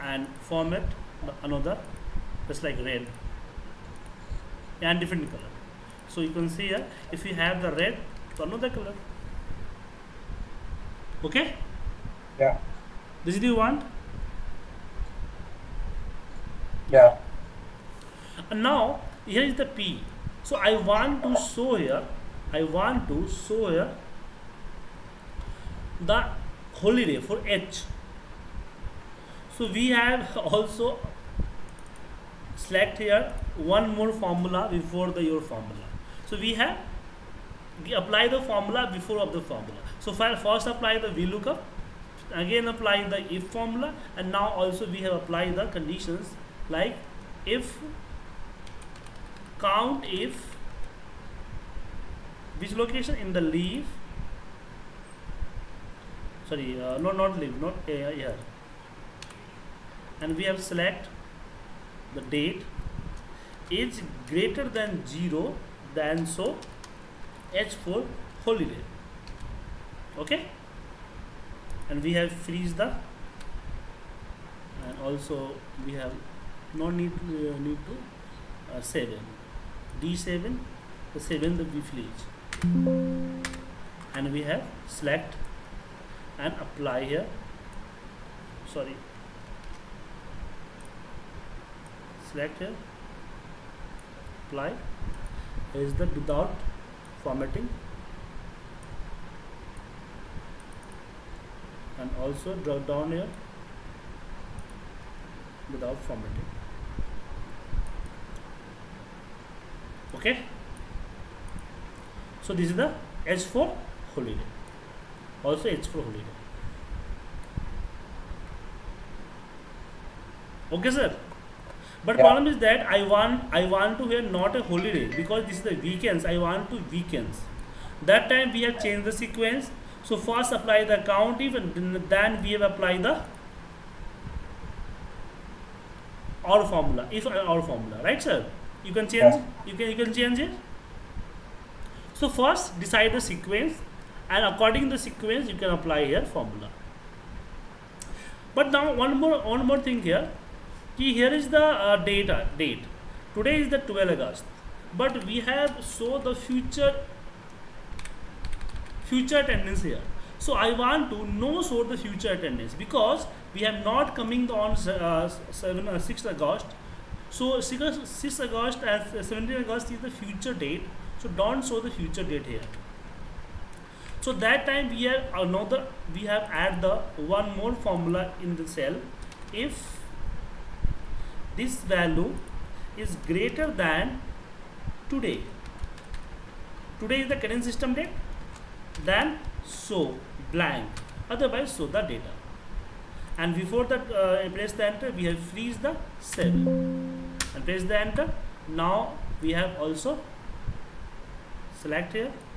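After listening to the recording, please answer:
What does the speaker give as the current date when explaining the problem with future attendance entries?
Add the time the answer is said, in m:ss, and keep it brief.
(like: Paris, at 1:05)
12 August, at 2:33.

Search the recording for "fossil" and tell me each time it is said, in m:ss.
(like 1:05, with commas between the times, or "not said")
not said.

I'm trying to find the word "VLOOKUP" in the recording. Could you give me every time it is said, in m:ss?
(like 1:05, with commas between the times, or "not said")
0:41.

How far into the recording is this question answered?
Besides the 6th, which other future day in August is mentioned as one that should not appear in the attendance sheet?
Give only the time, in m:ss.
2:49.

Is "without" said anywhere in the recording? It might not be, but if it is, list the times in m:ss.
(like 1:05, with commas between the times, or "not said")
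1:36, 1:45.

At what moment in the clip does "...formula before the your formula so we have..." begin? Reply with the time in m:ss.
0:34.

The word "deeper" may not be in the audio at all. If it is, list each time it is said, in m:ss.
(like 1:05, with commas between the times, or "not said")
not said.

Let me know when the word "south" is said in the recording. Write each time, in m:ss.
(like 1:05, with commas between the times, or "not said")
not said.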